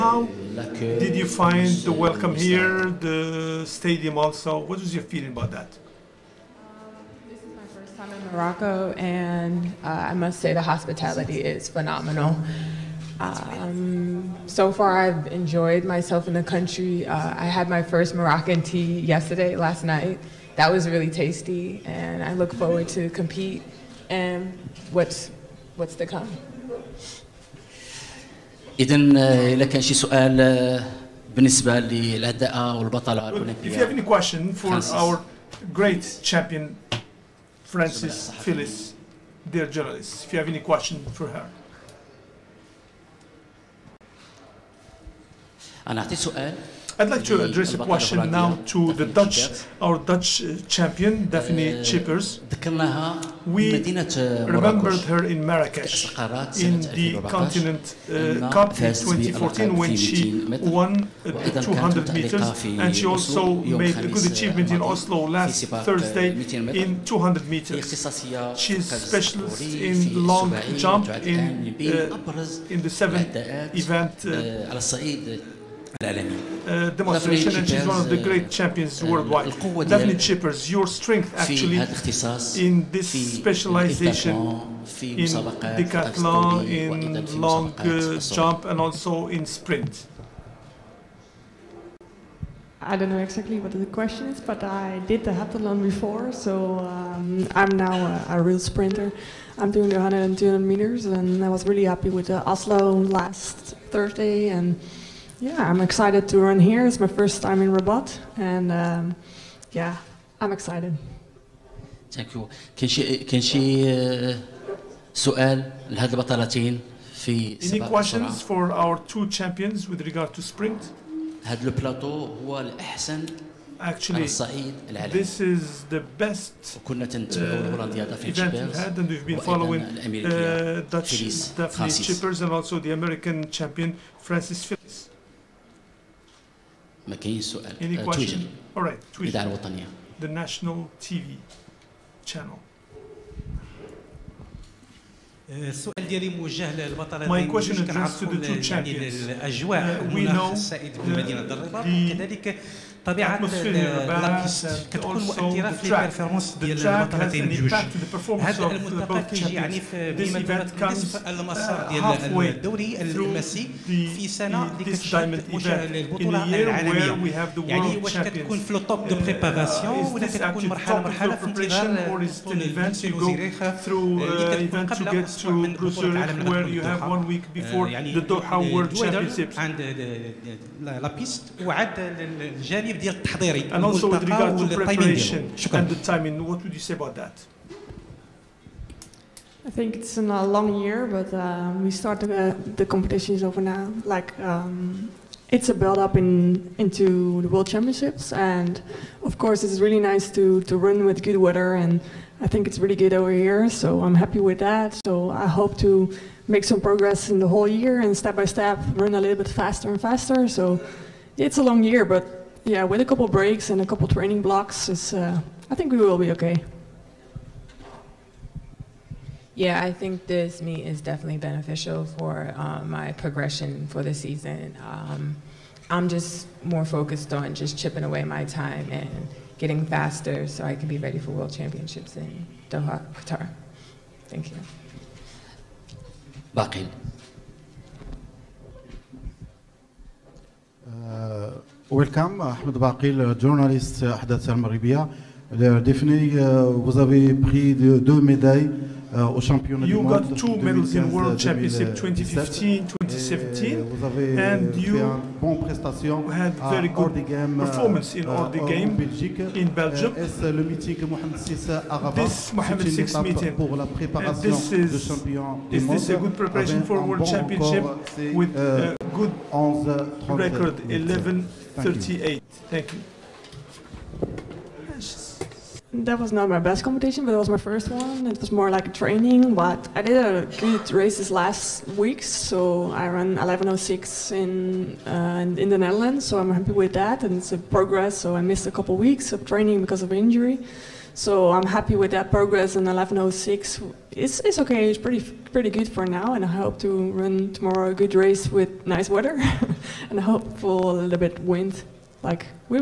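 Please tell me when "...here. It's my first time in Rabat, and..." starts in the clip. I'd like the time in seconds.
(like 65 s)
106 s.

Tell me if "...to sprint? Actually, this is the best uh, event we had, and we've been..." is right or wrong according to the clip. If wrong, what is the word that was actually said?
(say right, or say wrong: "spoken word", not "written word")
right.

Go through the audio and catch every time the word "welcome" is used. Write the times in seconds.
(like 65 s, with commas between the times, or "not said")
1 s, 241 s.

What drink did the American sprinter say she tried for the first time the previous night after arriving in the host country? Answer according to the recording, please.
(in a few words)
Moroccan tea.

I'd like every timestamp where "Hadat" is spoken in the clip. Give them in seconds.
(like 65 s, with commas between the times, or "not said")
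244 s.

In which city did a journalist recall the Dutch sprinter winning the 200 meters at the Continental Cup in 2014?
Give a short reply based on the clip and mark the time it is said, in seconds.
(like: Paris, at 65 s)
Marrakesh, at 55 s.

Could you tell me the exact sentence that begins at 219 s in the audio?
Yeah, I think this meet is definitely beneficial for uh, my progression for the season.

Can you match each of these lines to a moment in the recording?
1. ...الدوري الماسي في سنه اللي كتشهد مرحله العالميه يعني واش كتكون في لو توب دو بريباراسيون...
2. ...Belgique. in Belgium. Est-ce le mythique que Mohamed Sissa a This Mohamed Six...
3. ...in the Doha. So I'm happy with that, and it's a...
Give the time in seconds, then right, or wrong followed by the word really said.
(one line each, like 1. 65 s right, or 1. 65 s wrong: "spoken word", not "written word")
1. 162 s wrong: "البطوله", not "مرحله"
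2. 258 s right
3. 285 s wrong: "Netherlands", not "Doha".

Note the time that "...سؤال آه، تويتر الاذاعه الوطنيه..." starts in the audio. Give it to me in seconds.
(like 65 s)
137 s.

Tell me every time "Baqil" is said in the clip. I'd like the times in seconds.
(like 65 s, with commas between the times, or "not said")
236 s, 242 s.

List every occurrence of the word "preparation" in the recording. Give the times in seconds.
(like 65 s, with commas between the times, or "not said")
184 s, 266 s.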